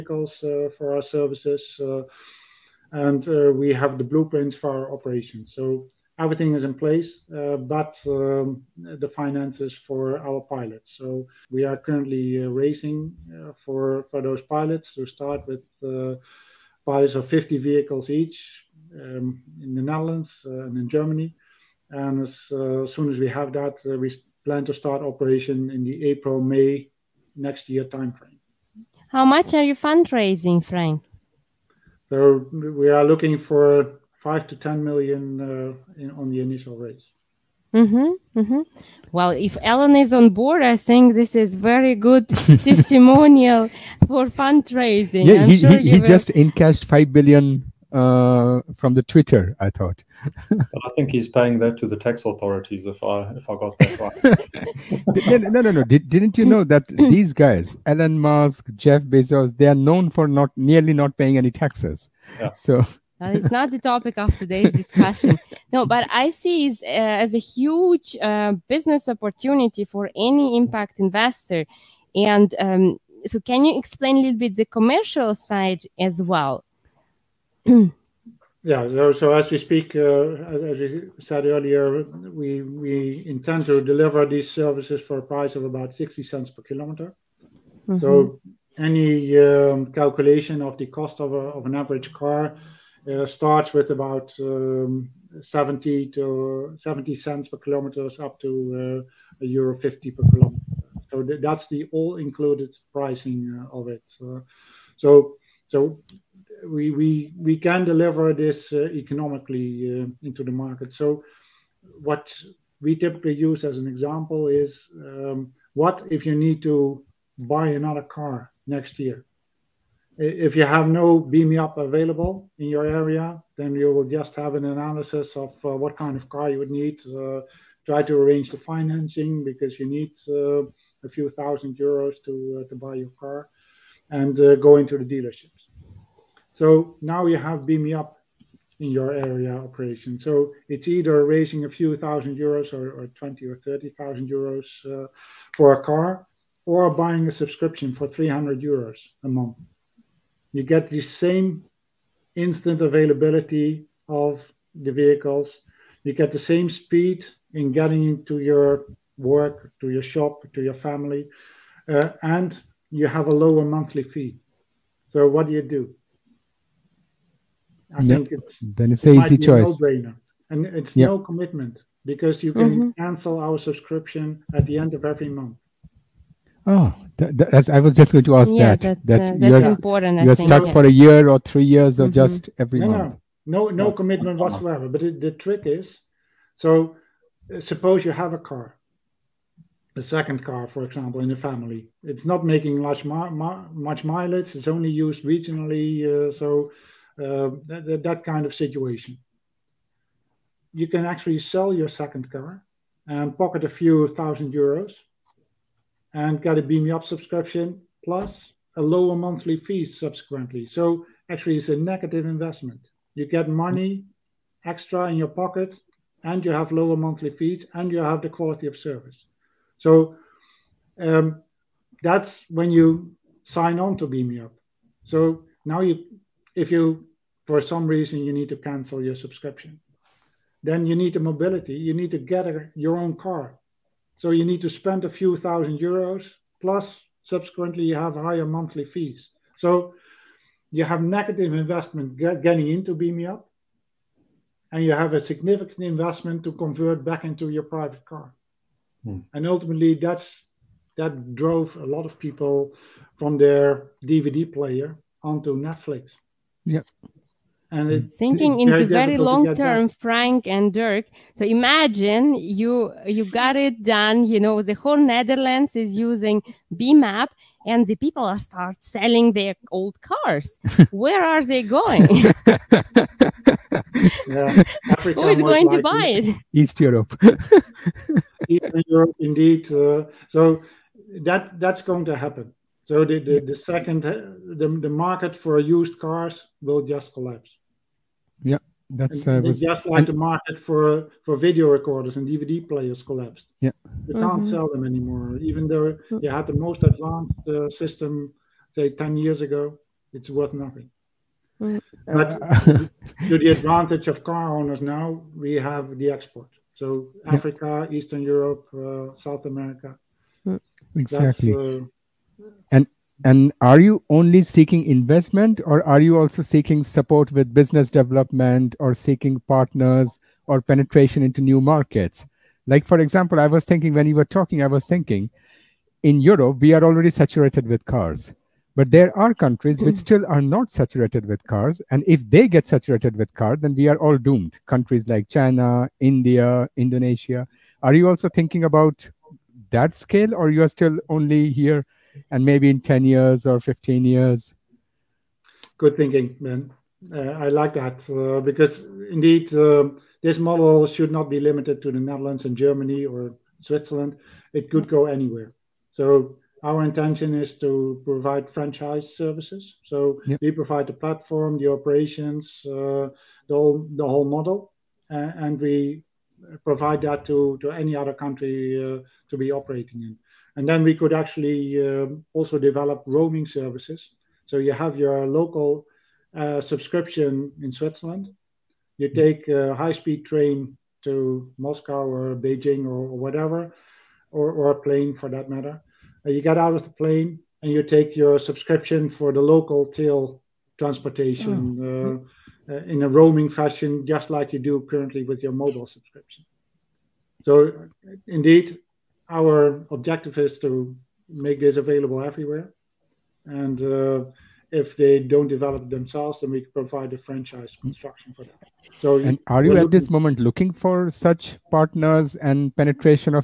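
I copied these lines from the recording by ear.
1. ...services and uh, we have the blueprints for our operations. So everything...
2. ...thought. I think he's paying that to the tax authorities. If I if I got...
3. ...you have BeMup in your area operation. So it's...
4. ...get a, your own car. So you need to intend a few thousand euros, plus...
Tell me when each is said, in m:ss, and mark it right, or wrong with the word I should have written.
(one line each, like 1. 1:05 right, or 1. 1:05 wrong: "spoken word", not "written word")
1. 0:01 right
2. 0:49 right
3. 2:17 right
4. 3:52 wrong: "spend", not "intend".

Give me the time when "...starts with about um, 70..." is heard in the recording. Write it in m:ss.
1:33.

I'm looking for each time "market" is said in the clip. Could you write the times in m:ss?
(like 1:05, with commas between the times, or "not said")
1:50, 4:44, 4:50, 5:21.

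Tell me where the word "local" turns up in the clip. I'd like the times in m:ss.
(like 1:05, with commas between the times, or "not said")
6:15, 6:29.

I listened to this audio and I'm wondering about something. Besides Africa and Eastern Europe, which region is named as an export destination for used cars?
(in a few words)
South America.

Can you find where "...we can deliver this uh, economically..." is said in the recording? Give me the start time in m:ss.
1:47.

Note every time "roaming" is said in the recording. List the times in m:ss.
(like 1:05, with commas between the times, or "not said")
6:13, 6:33.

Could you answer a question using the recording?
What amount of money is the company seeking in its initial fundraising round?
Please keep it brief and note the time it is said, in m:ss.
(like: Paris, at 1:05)
5 to 10 million, at 0:34.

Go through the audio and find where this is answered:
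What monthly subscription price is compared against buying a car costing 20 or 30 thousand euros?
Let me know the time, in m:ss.
2:28.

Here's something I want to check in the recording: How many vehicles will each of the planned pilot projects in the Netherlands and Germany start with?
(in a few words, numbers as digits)
50.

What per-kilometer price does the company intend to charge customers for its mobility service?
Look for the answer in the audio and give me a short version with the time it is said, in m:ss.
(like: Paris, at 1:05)
60 cents, at 1:25.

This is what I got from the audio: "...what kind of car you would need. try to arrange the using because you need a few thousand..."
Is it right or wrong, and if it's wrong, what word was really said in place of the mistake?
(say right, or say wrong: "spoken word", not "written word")
wrong: "financing", not "using".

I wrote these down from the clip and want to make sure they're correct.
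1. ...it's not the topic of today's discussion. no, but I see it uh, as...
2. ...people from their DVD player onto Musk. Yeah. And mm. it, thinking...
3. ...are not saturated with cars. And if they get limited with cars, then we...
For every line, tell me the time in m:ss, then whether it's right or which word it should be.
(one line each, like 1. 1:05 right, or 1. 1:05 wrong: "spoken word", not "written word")
1. 1:03 right
2. 4:12 wrong: "Netflix", not "Musk"
3. 5:30 wrong: "saturated", not "limited".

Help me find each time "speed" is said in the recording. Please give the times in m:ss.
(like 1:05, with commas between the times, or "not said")
2:36, 6:19.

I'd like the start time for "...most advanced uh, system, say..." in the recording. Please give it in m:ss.
4:56.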